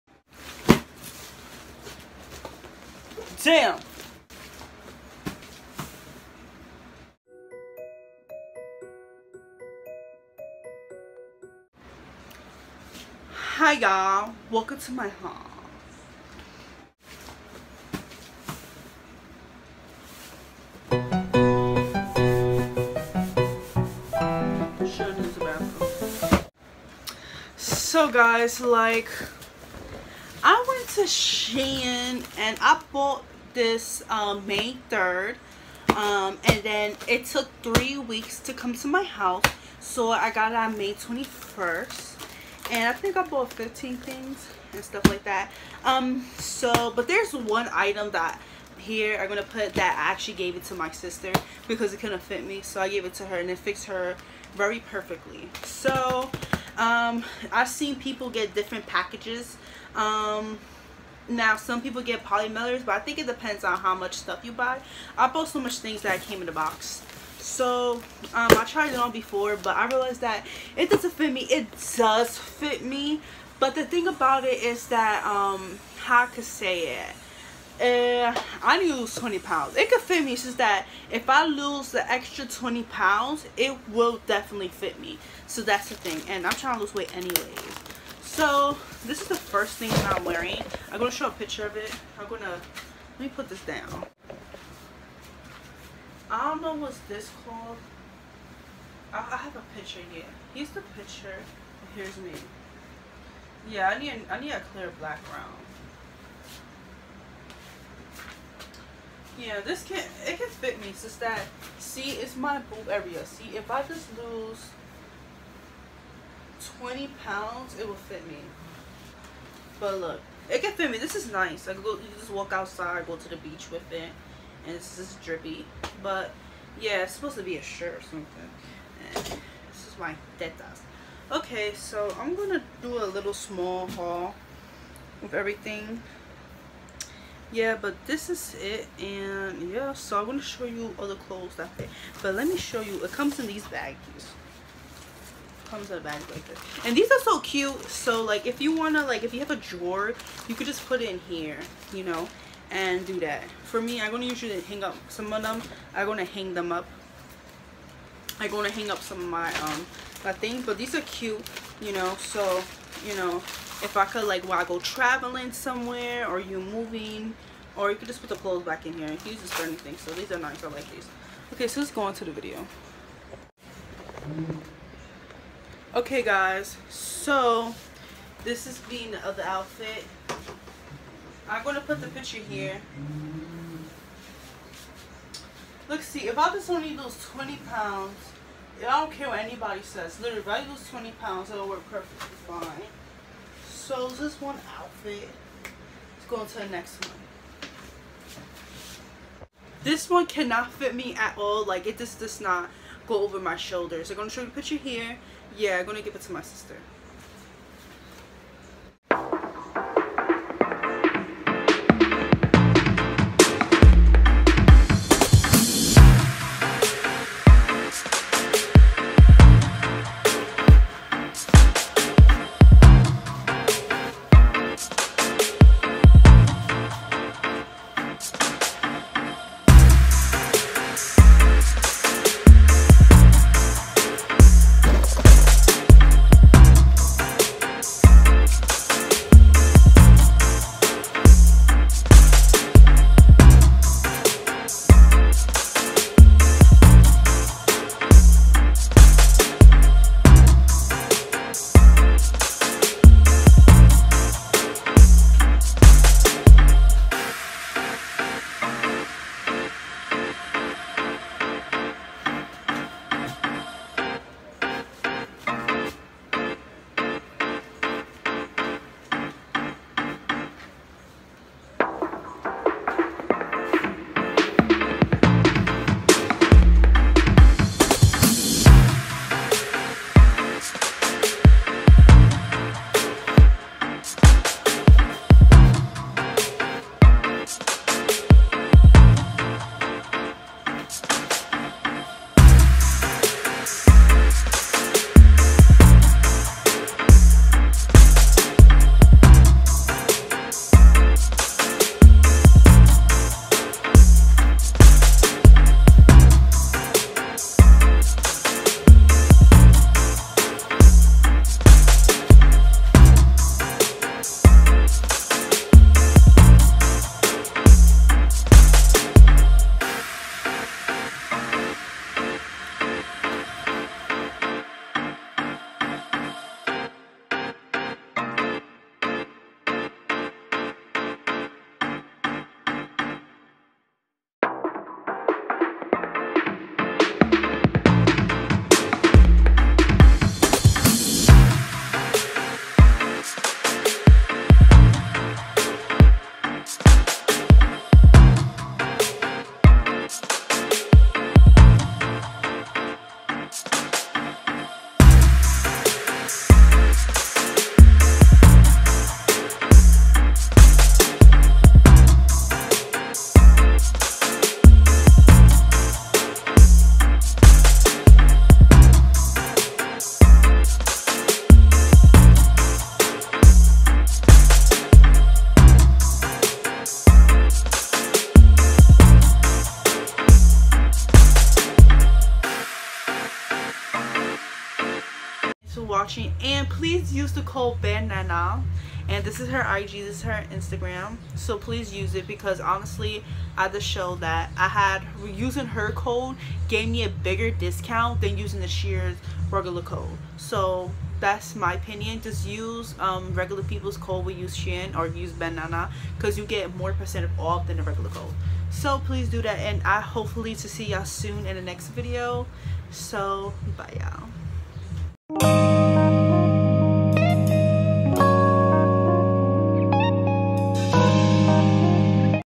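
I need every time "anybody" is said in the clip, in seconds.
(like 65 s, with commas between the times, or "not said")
189 s.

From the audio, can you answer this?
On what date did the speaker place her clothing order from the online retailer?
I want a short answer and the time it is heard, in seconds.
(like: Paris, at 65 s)
May 3rd, at 34 s.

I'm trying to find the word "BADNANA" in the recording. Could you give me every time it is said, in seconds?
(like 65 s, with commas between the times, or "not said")
387 s, 405 s.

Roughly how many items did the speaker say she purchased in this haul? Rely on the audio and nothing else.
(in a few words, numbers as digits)
15.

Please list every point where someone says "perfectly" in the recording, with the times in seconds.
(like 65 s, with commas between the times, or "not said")
54 s, 191 s.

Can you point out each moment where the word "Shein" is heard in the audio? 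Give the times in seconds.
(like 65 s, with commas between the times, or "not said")
31 s, 398 s, 404 s.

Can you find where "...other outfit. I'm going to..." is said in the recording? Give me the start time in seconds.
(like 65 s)
179 s.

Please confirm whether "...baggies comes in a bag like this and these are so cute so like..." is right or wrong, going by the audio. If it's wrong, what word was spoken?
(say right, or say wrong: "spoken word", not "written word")
right.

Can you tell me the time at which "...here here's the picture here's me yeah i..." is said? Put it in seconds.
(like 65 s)
100 s.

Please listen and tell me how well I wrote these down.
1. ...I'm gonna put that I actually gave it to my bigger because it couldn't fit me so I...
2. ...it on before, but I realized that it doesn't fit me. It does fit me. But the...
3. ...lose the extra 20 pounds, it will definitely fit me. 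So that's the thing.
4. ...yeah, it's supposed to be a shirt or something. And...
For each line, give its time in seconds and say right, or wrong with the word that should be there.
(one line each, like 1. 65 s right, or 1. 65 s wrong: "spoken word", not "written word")
1. 49 s wrong: "sister", not "bigger"
2. 68 s right
3. 81 s right
4. 126 s right.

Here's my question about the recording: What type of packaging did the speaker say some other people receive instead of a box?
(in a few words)
polymailers.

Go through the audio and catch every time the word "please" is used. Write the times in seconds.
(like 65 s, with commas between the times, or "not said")
386 s, 391 s, 409 s.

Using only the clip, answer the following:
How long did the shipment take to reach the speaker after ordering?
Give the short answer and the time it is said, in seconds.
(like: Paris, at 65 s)
three weeks, at 37 s.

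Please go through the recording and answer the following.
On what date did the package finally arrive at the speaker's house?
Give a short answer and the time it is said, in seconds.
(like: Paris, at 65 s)
May 21st, at 40 s.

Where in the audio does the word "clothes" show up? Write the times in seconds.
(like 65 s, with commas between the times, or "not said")
141 s, 168 s.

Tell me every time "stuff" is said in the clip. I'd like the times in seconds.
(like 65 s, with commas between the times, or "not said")
44 s, 64 s.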